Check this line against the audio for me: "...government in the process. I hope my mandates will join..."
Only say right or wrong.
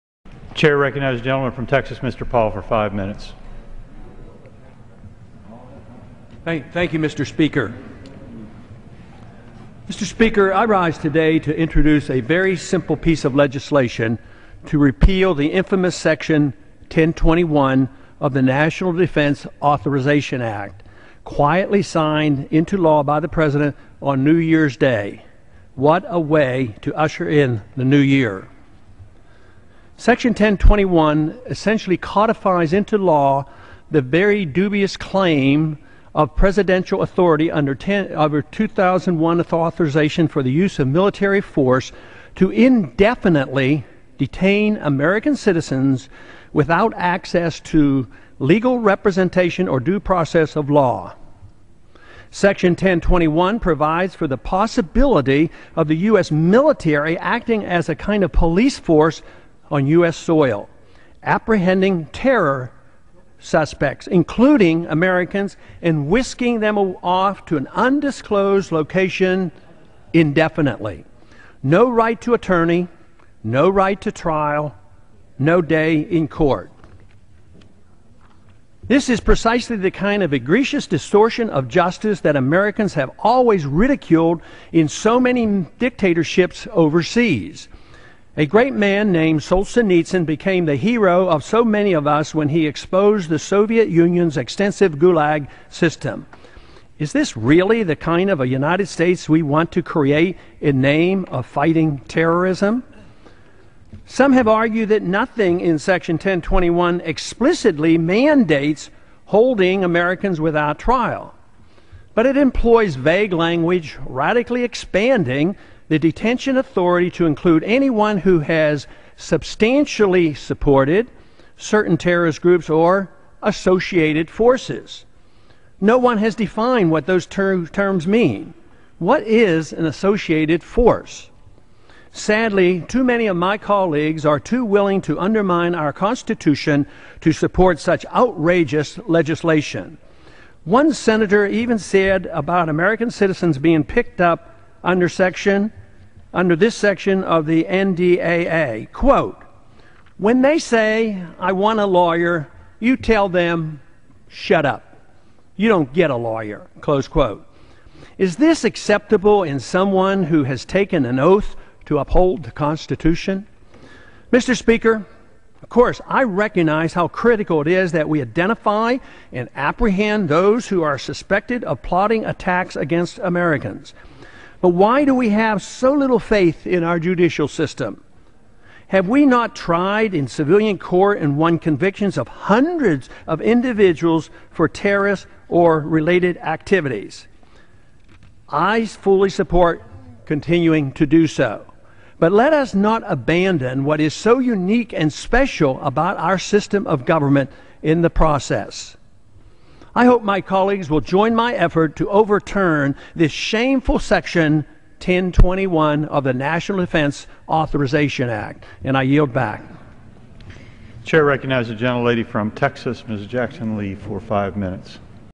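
wrong.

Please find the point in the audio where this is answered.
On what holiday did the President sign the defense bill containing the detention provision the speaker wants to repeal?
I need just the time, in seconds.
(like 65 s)
24 s.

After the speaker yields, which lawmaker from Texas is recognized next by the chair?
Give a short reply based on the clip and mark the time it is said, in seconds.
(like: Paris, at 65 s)
Ms. Jackson Lee, at 213 s.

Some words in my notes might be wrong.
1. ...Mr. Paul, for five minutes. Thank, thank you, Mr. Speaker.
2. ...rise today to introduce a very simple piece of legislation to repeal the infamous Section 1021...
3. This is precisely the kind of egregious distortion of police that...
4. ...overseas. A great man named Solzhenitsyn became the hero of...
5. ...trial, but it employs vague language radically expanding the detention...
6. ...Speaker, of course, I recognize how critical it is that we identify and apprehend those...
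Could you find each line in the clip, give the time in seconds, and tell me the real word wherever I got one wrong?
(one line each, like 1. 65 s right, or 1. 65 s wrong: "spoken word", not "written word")
1. 2 s right
2. 10 s right
3. 78 s wrong: "justice", not "police"
4. 86 s right
5. 110 s right
6. 164 s right.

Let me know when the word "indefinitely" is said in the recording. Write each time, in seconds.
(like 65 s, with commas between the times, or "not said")
42 s, 70 s.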